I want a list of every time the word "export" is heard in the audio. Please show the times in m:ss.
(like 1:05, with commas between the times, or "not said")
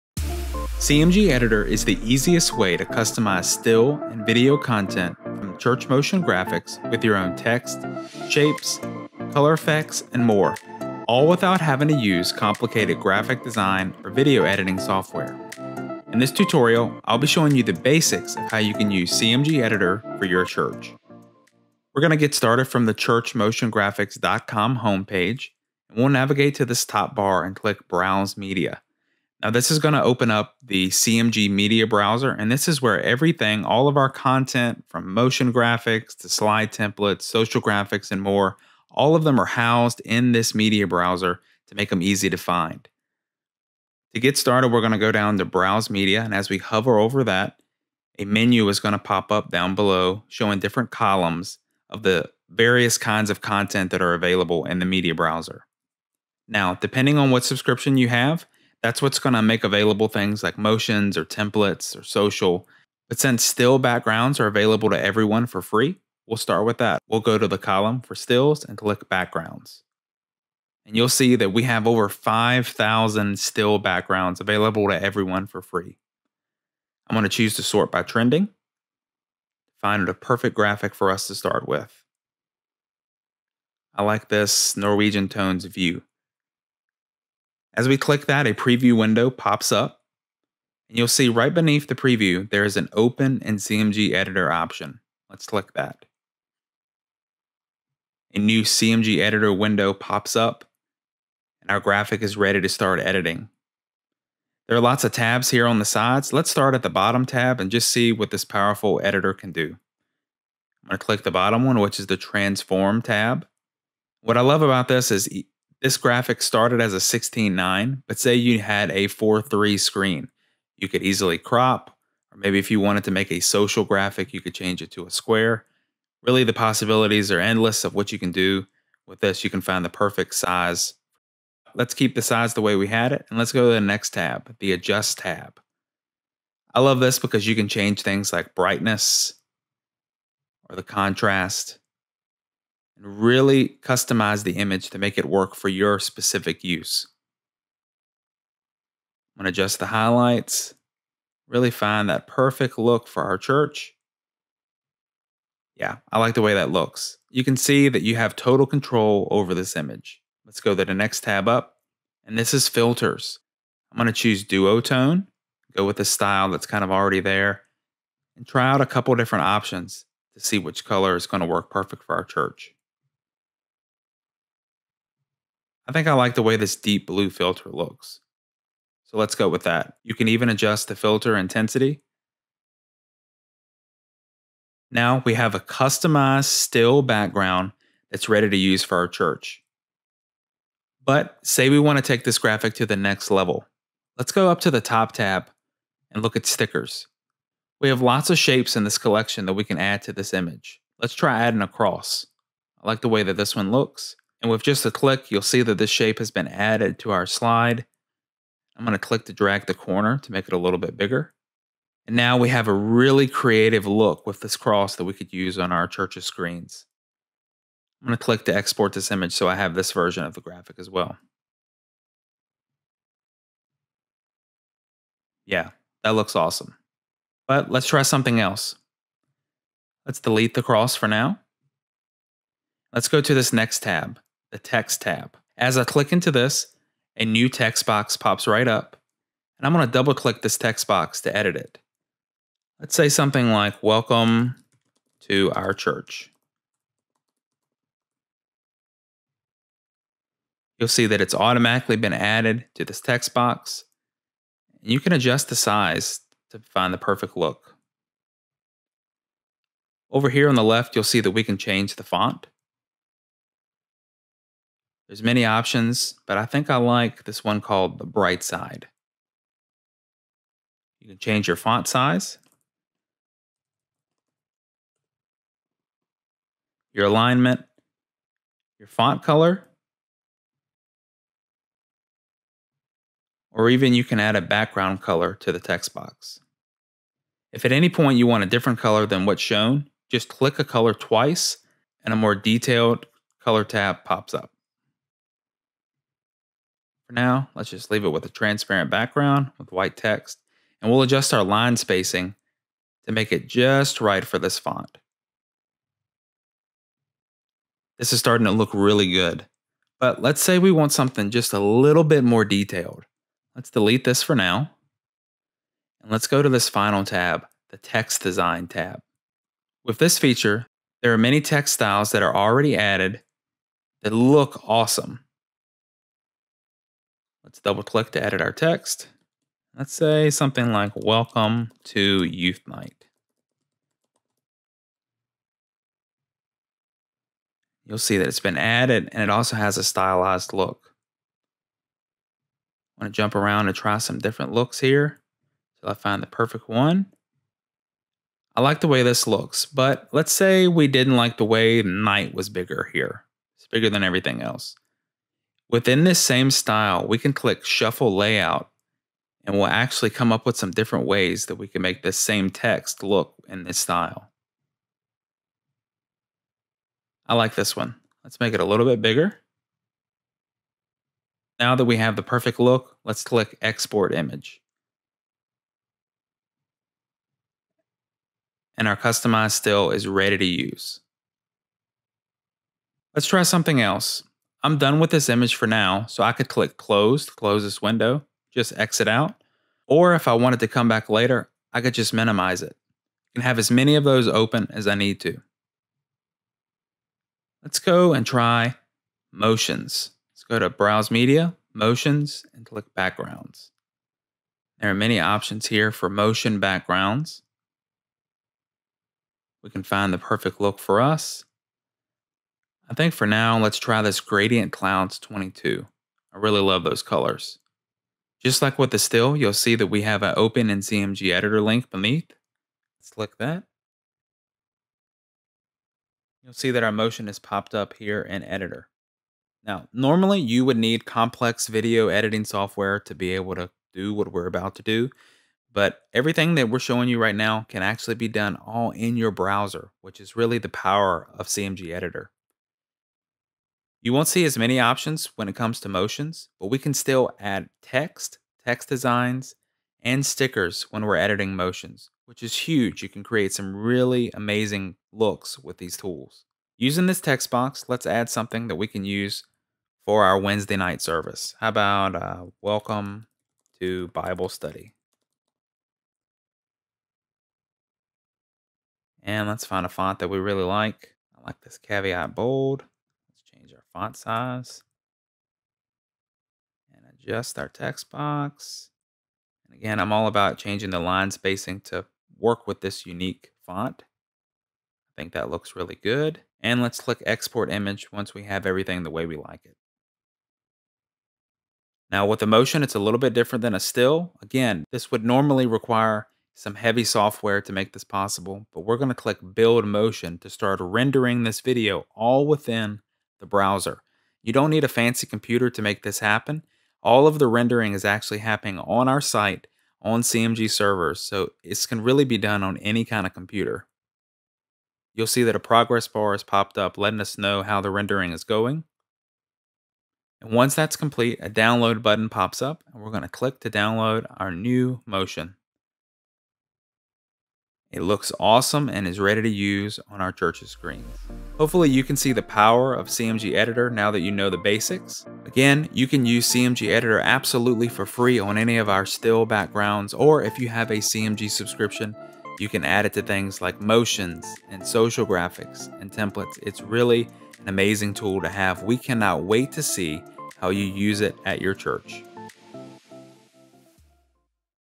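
3:38, 6:13, 8:07.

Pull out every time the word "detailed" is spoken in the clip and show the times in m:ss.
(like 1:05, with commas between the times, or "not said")
4:52, 5:12.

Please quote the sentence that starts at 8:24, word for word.
You don't need a fancy computer to make this happen.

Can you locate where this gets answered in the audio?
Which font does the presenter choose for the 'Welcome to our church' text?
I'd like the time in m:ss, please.
4:27.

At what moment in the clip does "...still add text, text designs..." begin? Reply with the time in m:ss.
7:26.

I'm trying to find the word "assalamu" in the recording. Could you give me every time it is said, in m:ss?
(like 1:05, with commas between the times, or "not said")
not said.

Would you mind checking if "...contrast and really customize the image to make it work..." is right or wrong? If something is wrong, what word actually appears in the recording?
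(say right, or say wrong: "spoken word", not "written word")
right.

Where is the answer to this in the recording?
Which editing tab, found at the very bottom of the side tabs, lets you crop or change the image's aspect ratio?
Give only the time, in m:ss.
1:52.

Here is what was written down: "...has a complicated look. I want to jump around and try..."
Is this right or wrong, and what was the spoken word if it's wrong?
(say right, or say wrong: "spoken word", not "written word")
wrong: "stylized", not "complicated".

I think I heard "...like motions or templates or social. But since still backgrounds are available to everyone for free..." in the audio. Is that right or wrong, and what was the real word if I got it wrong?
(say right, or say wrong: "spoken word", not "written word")
right.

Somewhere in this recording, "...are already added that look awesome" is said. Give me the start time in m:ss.
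5:22.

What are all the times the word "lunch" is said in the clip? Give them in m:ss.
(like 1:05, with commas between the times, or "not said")
not said.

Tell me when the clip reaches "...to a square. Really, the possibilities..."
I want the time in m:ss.
2:04.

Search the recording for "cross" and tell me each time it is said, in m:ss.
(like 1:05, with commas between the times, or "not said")
3:21, 3:34, 3:50.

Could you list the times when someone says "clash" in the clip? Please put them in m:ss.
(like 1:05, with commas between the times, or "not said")
not said.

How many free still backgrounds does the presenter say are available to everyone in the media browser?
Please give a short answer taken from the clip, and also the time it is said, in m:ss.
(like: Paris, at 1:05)
over 5,000, at 1:11.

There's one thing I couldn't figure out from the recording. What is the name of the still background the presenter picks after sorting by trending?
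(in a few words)
Norwegian tones view.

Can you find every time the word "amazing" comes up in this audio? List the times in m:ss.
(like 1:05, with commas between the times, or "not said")
7:34, 9:07.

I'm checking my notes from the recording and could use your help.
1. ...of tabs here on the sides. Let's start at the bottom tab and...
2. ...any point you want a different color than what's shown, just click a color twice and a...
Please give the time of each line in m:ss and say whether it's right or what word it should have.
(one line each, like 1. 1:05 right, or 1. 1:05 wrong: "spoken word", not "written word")
1. 1:45 right
2. 4:47 right.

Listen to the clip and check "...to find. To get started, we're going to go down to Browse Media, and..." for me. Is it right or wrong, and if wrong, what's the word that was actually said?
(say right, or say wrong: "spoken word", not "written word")
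right.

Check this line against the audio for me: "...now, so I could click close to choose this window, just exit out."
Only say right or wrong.
wrong.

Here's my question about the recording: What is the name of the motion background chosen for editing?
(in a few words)
Gradient Clouds 22.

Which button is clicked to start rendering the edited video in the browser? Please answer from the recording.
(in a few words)
build motion.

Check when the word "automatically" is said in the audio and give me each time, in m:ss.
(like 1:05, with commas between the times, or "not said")
4:11.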